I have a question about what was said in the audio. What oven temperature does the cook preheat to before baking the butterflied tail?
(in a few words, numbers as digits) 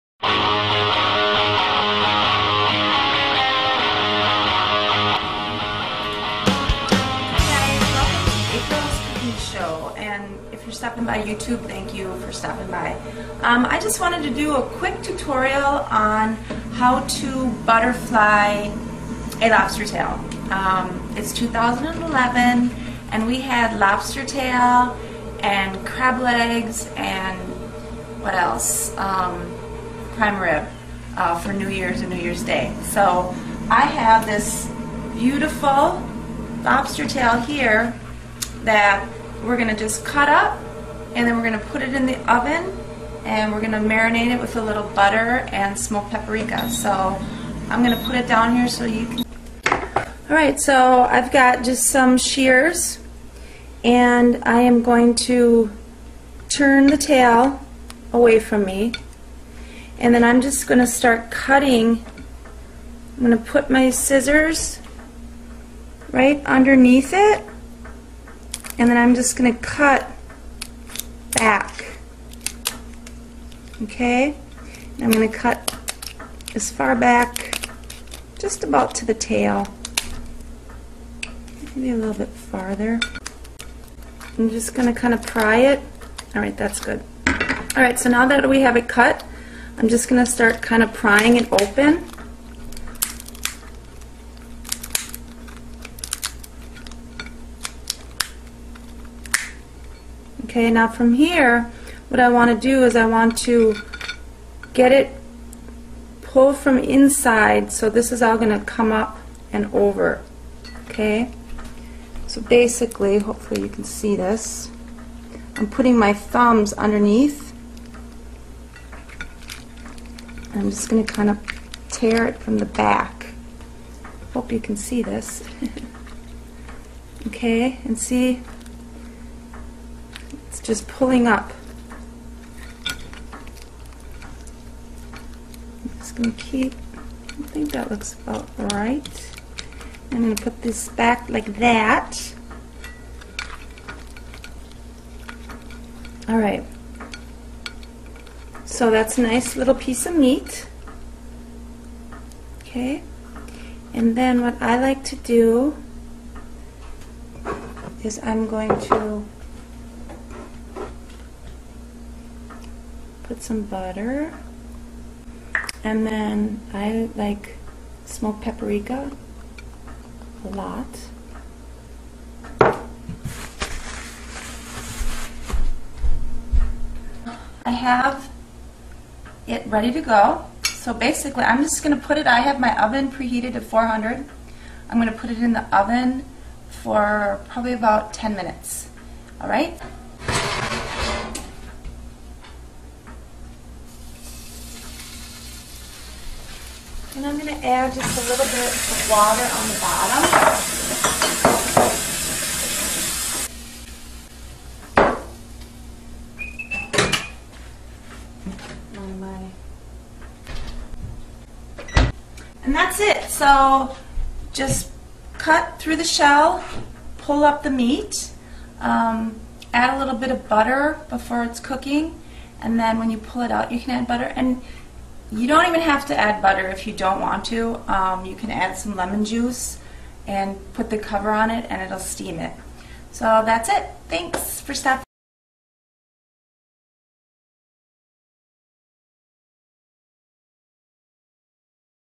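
400.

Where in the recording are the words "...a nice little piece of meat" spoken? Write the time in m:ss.
2:29.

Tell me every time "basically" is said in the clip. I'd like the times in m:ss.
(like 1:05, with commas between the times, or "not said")
1:52, 3:00.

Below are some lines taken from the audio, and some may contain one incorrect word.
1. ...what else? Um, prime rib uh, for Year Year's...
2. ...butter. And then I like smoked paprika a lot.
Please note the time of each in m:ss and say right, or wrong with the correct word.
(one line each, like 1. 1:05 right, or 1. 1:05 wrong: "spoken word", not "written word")
1. 0:28 wrong: "New", not "Year"
2. 2:43 right.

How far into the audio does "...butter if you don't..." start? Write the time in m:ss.
3:46.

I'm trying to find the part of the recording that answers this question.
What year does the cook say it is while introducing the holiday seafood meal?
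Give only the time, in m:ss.
0:21.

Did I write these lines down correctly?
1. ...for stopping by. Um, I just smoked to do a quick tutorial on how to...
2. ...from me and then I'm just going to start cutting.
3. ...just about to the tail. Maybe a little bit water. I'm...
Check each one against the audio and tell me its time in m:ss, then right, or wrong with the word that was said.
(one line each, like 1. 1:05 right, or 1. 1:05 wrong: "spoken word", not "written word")
1. 0:12 wrong: "wanted", not "smoked"
2. 0:58 right
3. 1:18 wrong: "farther", not "water".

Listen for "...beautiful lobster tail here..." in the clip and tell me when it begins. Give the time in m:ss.
0:35.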